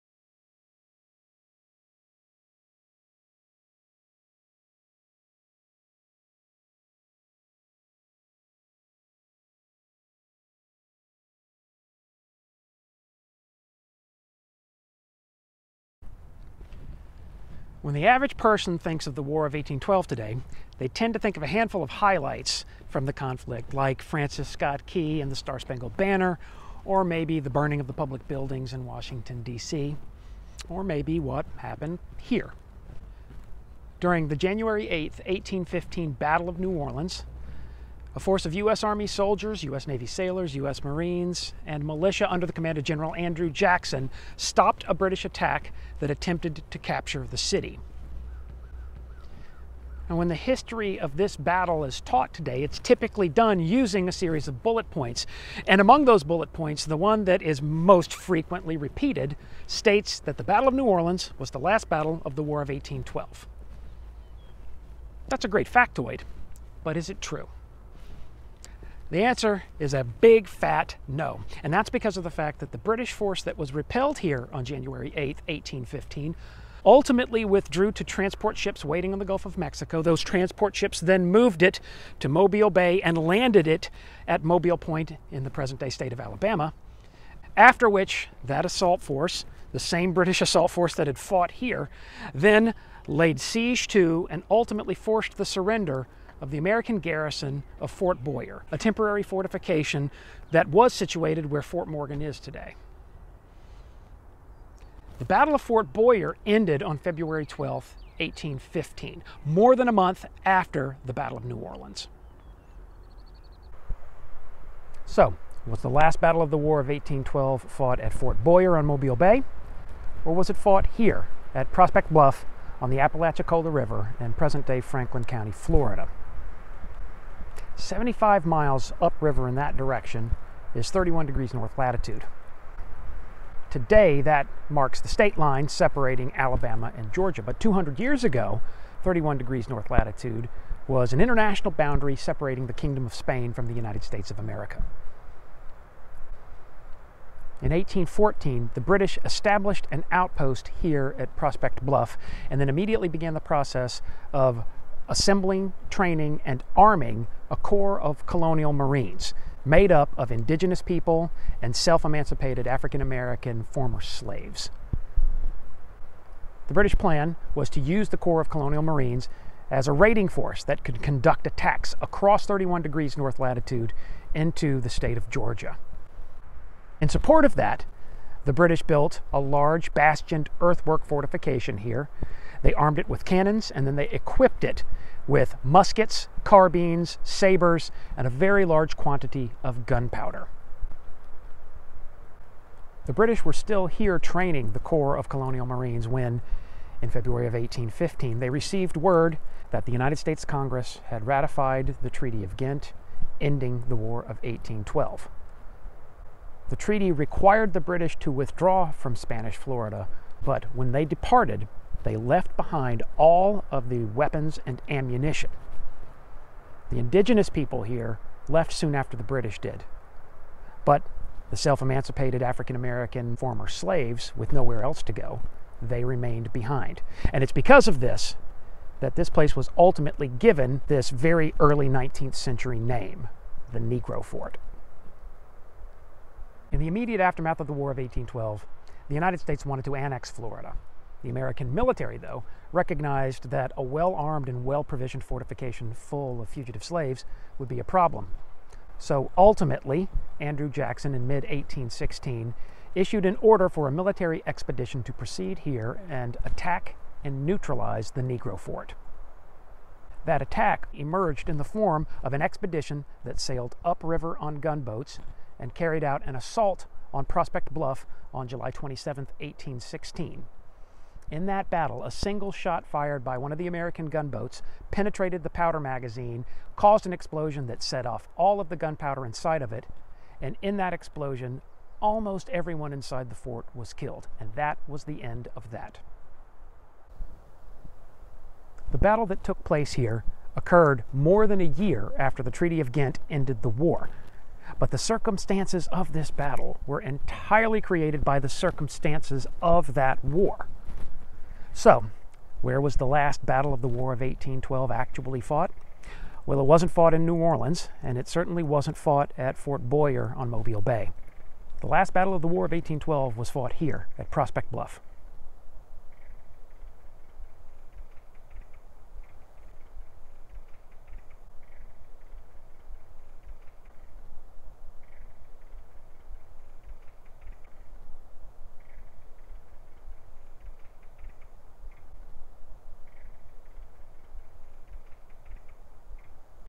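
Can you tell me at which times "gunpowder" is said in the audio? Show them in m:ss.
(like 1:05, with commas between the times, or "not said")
3:09, 4:38.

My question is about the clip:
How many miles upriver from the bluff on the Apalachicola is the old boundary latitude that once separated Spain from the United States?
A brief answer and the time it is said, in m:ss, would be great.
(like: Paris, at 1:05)
75, at 2:07.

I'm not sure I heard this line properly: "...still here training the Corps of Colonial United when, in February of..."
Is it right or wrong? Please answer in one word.
wrong.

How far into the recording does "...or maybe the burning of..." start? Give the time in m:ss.
0:26.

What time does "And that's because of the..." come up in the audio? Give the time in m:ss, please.
1:11.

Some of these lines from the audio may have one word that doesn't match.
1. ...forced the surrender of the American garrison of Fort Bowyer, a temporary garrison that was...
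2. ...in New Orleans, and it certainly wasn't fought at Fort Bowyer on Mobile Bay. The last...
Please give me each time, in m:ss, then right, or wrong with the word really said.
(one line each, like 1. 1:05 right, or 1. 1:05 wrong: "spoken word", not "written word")
1. 1:34 wrong: "fortification", not "garrison"
2. 5:07 right.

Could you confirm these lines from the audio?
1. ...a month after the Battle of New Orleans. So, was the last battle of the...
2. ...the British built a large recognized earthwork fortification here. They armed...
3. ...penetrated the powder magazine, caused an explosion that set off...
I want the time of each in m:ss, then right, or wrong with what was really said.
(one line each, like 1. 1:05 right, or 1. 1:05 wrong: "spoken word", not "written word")
1. 1:49 right
2. 2:58 wrong: "bastioned", not "recognized"
3. 4:34 right.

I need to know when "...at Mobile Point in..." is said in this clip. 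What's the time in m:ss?
1:24.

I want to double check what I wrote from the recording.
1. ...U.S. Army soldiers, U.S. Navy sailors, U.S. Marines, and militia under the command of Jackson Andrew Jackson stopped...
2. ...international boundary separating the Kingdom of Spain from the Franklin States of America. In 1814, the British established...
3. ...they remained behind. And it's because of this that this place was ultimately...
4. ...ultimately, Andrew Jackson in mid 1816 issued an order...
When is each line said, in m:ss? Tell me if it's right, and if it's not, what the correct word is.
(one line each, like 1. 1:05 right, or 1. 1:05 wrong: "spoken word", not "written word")
1. 0:38 wrong: "General", not "Jackson"
2. 2:21 wrong: "United", not "Franklin"
3. 3:45 right
4. 4:09 right.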